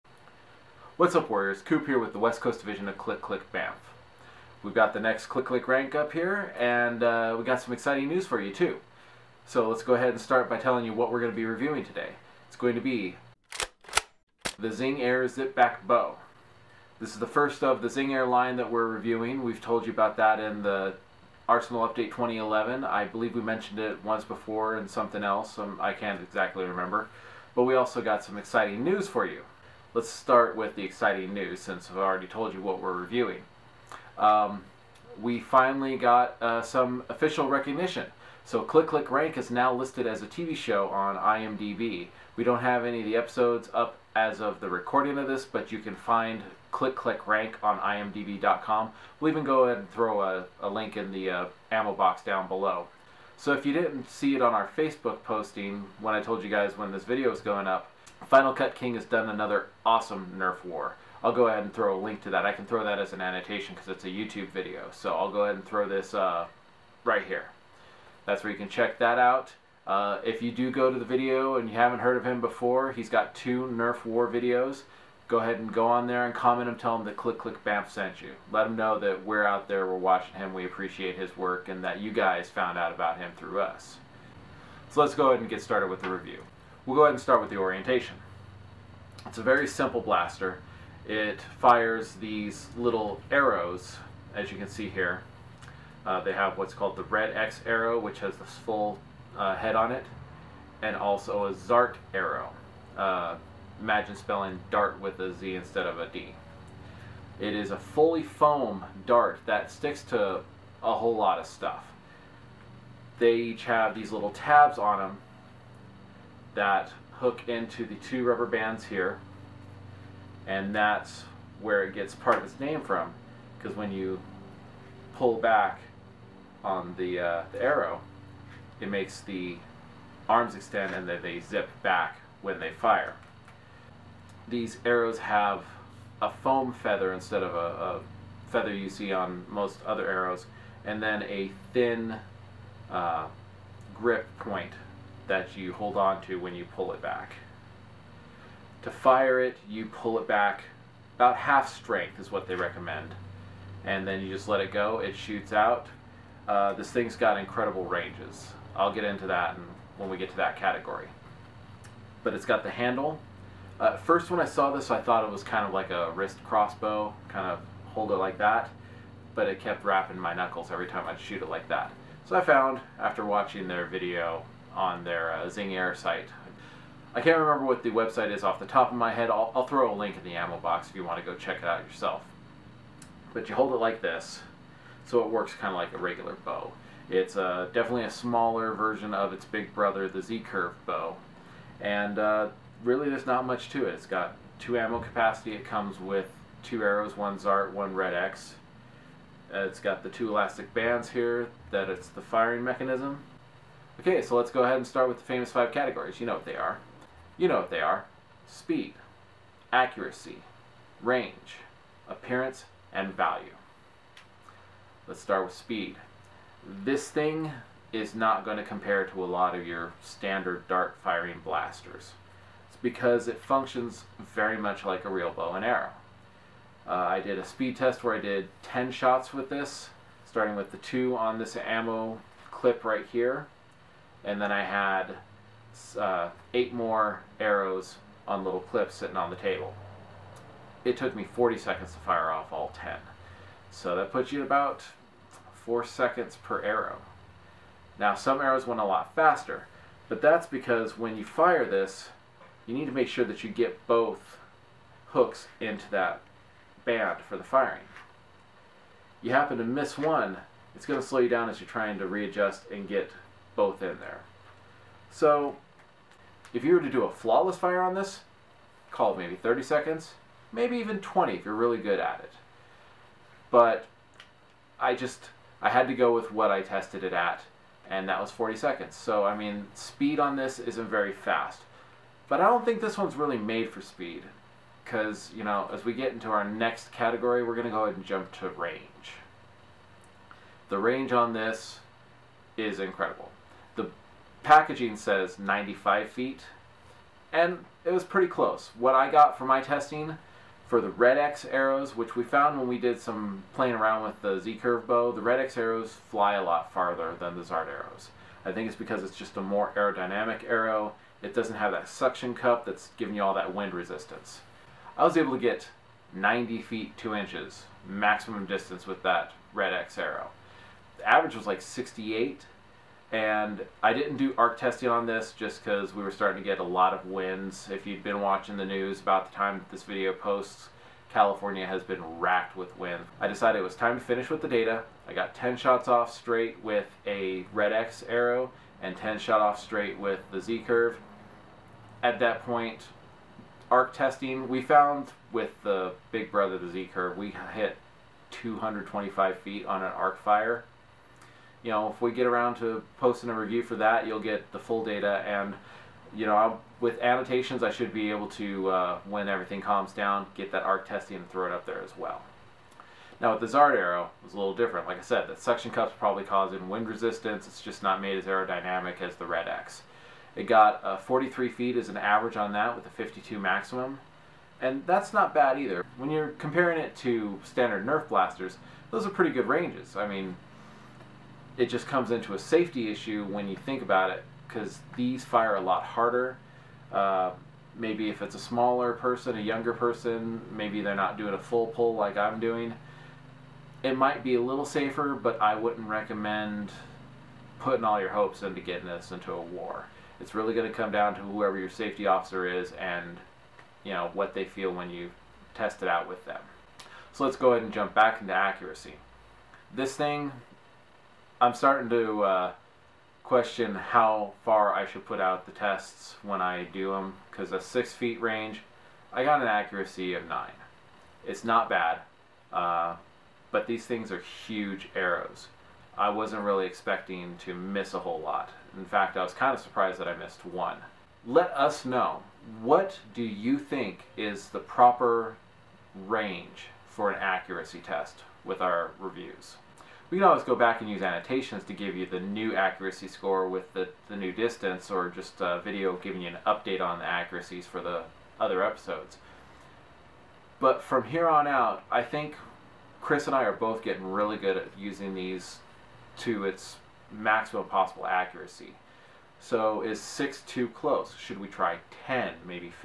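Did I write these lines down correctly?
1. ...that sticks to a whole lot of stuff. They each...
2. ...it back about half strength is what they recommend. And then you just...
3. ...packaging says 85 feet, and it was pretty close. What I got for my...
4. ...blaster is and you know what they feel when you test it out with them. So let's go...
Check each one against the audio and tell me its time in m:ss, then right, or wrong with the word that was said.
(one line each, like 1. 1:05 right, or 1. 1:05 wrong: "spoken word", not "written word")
1. 1:49 right
2. 2:30 right
3. 4:54 wrong: "95", not "85"
4. 6:42 wrong: "officer", not "blaster".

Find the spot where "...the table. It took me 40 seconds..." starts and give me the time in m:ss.
3:59.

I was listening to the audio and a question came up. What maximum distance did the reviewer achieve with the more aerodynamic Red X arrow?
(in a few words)
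90 feet 2 inches.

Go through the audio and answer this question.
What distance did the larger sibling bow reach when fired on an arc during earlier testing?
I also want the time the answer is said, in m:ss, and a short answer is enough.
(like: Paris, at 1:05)
225 feet, at 5:48.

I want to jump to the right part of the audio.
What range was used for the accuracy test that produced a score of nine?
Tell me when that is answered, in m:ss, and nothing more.
6:57.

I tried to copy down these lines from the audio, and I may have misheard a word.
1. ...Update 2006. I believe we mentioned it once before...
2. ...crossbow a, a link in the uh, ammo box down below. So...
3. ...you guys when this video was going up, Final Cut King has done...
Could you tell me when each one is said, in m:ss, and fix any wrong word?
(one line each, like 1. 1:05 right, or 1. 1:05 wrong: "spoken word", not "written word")
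1. 0:21 wrong: "2011", not "2006"
2. 0:49 wrong: "throw", not "crossbow"
3. 0:56 right.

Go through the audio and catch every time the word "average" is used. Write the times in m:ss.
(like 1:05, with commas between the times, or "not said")
5:21, 6:11.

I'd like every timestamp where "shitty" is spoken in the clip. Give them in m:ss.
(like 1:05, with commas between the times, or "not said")
not said.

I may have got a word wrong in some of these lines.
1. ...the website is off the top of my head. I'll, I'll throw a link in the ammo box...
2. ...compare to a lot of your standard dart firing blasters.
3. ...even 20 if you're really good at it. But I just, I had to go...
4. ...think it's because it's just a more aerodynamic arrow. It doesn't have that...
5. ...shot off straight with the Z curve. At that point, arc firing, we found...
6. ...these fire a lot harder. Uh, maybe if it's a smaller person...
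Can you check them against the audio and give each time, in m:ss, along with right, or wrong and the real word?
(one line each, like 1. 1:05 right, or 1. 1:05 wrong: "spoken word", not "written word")
1. 2:57 right
2. 3:38 right
3. 4:30 right
4. 5:08 right
5. 5:39 wrong: "testing", not "firing"
6. 6:24 right.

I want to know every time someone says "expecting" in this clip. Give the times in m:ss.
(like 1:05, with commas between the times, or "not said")
7:06.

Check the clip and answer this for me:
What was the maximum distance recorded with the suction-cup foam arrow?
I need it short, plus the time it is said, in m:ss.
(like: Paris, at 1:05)
52 feet, at 6:12.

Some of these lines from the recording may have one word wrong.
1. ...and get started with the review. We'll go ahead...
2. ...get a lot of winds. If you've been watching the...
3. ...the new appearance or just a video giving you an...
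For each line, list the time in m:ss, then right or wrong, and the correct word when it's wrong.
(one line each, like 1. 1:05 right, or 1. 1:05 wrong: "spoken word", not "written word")
1. 1:25 right
2. 5:26 right
3. 7:24 wrong: "distance", not "appearance".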